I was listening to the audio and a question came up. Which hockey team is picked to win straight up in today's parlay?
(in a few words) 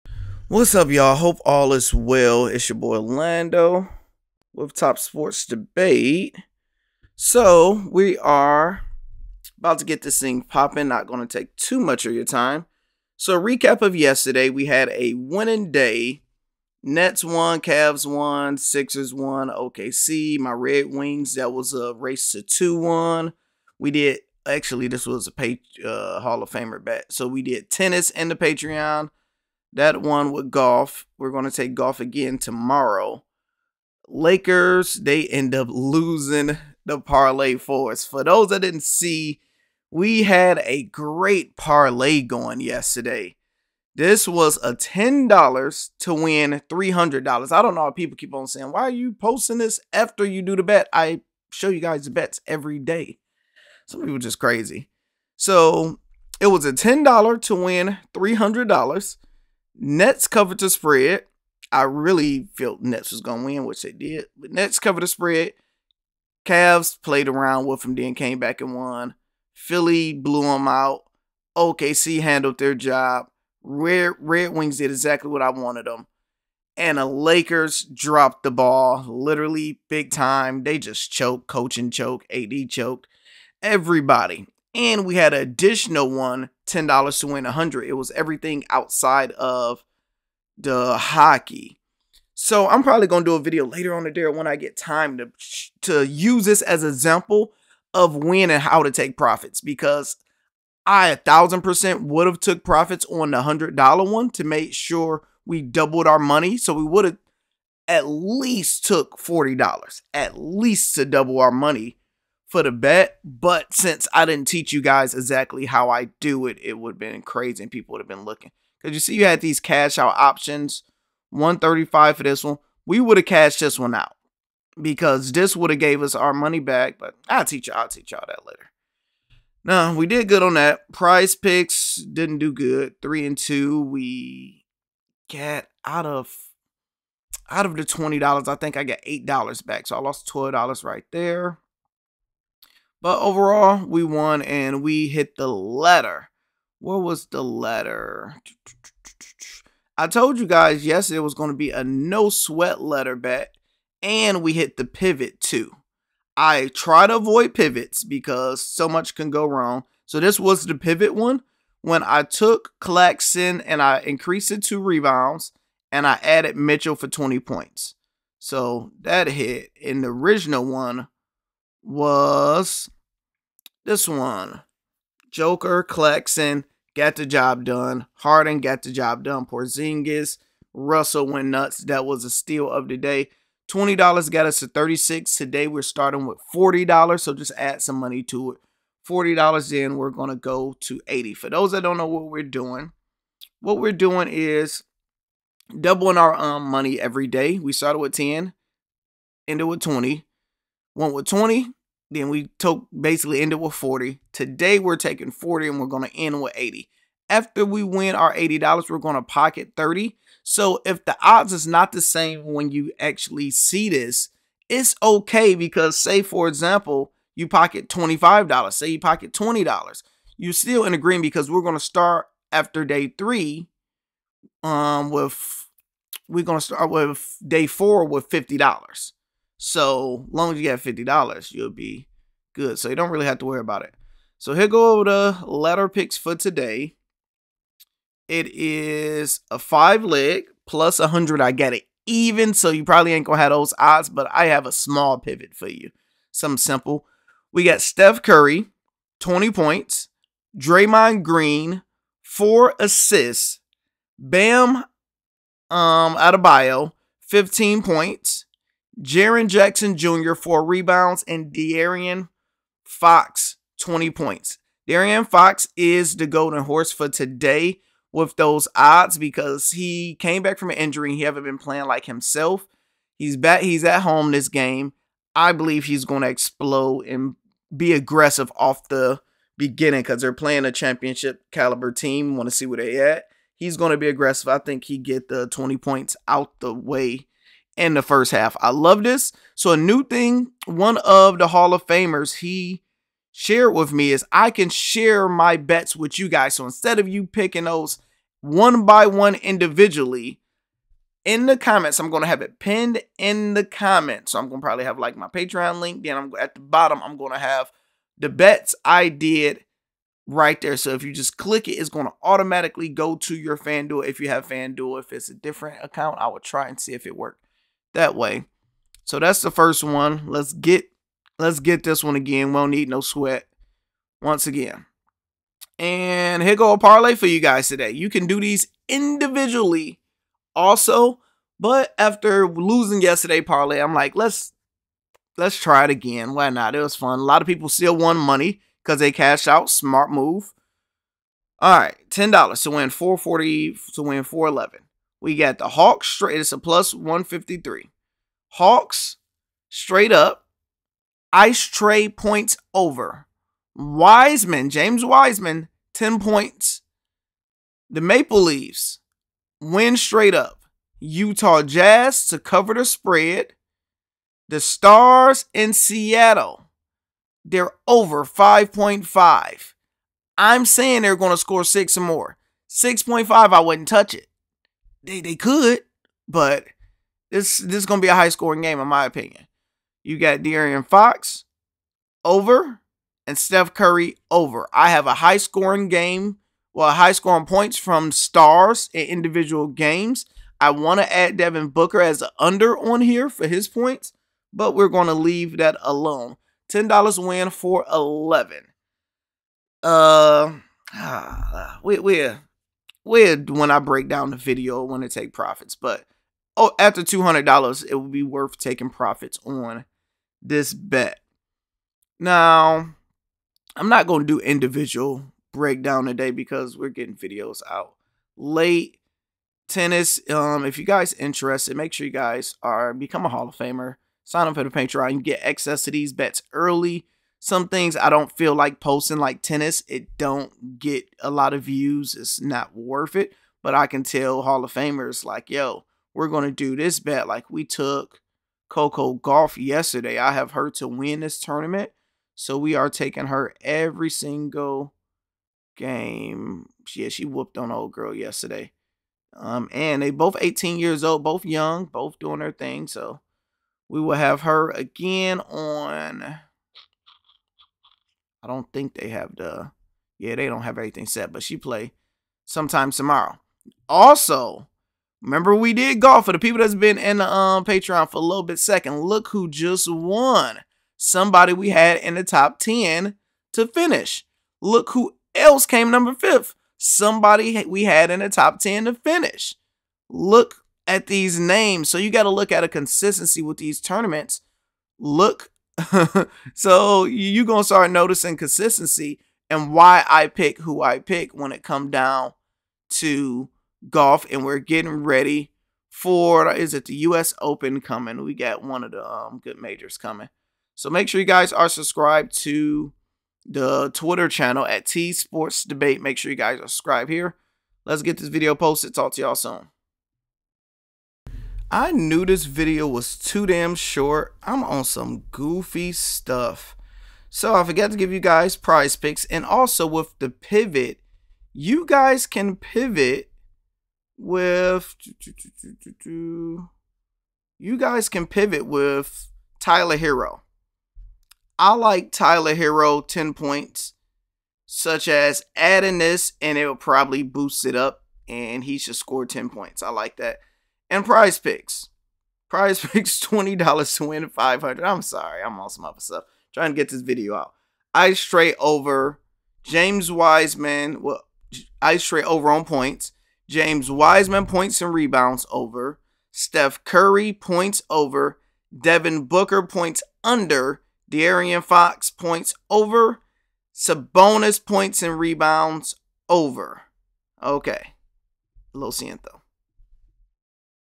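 Maple Leafs.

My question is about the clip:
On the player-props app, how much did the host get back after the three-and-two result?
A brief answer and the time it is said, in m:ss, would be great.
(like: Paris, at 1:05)
8 dollars, at 2:19.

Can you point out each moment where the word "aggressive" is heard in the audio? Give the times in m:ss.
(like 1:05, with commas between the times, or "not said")
4:37, 4:44.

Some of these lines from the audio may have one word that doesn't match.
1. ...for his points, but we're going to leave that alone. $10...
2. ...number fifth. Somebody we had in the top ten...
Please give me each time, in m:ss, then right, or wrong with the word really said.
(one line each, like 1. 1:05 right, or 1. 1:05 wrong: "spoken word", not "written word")
1. 6:33 right
2. 7:55 right.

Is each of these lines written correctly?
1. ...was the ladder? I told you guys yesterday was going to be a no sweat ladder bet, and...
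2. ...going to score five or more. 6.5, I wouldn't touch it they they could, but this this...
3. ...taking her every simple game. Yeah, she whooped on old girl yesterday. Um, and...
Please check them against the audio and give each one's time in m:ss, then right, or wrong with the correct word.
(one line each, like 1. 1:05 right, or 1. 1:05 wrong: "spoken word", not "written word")
1. 2:27 right
2. 6:11 wrong: "six", not "five"
3. 7:22 wrong: "single", not "simple".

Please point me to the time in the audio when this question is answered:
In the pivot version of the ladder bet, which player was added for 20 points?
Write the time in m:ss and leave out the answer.
2:46.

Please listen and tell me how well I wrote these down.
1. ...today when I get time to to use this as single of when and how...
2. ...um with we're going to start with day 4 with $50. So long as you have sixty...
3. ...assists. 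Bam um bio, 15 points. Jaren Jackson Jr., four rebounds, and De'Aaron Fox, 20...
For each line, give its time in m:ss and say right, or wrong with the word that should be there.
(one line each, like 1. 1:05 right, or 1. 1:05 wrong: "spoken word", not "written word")
1. 1:34 wrong: "example", not "single"
2. 3:44 wrong: "fifty", not "sixty"
3. 4:12 right.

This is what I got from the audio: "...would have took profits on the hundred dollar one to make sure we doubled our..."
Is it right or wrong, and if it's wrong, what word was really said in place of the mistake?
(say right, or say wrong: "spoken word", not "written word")
right.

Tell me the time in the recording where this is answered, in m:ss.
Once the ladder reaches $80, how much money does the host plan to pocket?
3:29.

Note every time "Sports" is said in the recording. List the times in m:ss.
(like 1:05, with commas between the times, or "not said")
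0:04, 8:25.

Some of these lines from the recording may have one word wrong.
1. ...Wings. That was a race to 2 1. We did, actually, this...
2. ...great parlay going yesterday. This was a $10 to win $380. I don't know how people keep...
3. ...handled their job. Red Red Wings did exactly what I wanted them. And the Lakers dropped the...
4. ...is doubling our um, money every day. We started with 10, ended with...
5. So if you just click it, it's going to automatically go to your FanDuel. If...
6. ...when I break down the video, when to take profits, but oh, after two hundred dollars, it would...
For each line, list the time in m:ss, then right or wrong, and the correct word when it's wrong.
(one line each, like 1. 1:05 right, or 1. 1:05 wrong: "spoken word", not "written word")
1. 0:20 right
2. 0:40 wrong: "300", not "380"
3. 1:12 right
4. 3:14 right
5. 5:10 right
6. 6:43 right.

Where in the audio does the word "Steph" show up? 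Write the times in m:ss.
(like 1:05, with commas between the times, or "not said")
4:07, 6:23, 9:16.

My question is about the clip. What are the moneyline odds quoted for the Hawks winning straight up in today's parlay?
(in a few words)
+153.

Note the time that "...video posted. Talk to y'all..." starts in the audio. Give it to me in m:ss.
8:28.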